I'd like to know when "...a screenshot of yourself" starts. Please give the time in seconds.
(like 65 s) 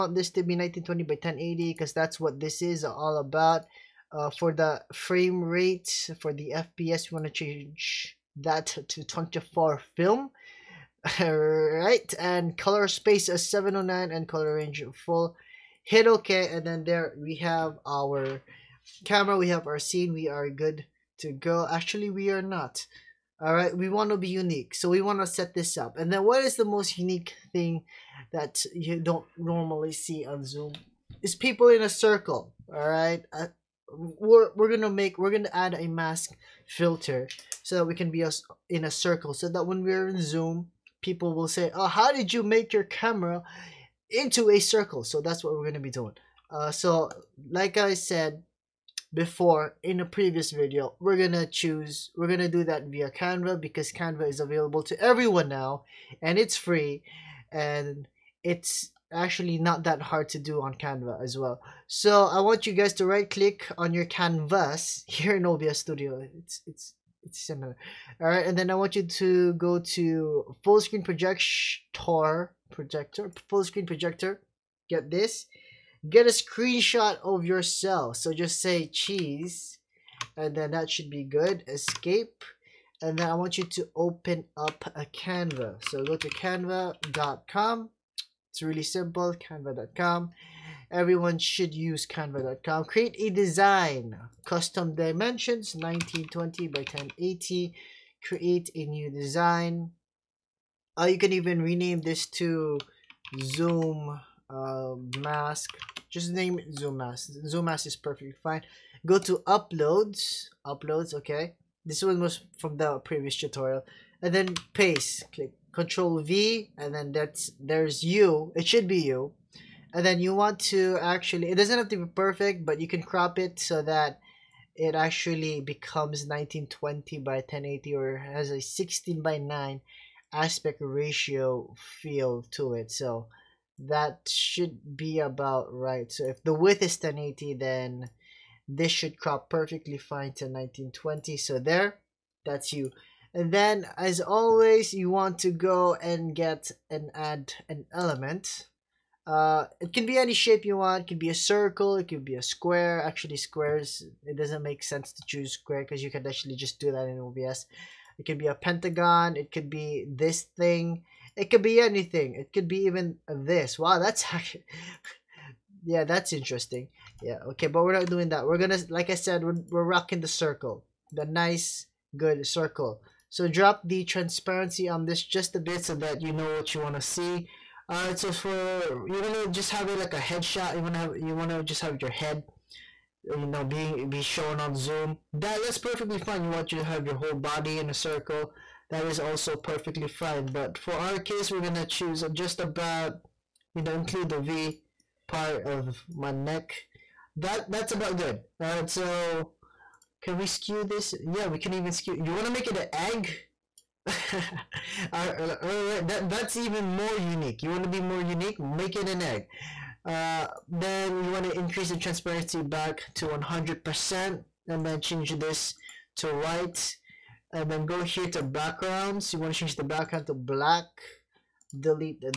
76 s.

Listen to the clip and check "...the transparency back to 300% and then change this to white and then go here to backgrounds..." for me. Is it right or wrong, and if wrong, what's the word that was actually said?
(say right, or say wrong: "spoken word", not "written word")
wrong: "100", not "300".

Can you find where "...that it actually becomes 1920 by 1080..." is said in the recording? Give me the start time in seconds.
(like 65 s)
123 s.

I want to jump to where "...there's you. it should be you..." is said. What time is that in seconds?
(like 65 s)
117 s.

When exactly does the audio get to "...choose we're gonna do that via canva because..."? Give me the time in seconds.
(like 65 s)
51 s.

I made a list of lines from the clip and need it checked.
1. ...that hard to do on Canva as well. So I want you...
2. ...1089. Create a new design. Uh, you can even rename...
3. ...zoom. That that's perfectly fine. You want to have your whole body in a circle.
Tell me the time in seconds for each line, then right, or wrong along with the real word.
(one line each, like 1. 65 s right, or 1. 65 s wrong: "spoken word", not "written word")
1. 59 s right
2. 96 s wrong: "1080", not "1089"
3. 184 s right.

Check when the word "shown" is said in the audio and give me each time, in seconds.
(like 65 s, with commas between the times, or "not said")
184 s.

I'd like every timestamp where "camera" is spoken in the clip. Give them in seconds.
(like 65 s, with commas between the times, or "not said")
19 s, 42 s.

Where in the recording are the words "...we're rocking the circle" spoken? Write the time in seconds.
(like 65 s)
169 s.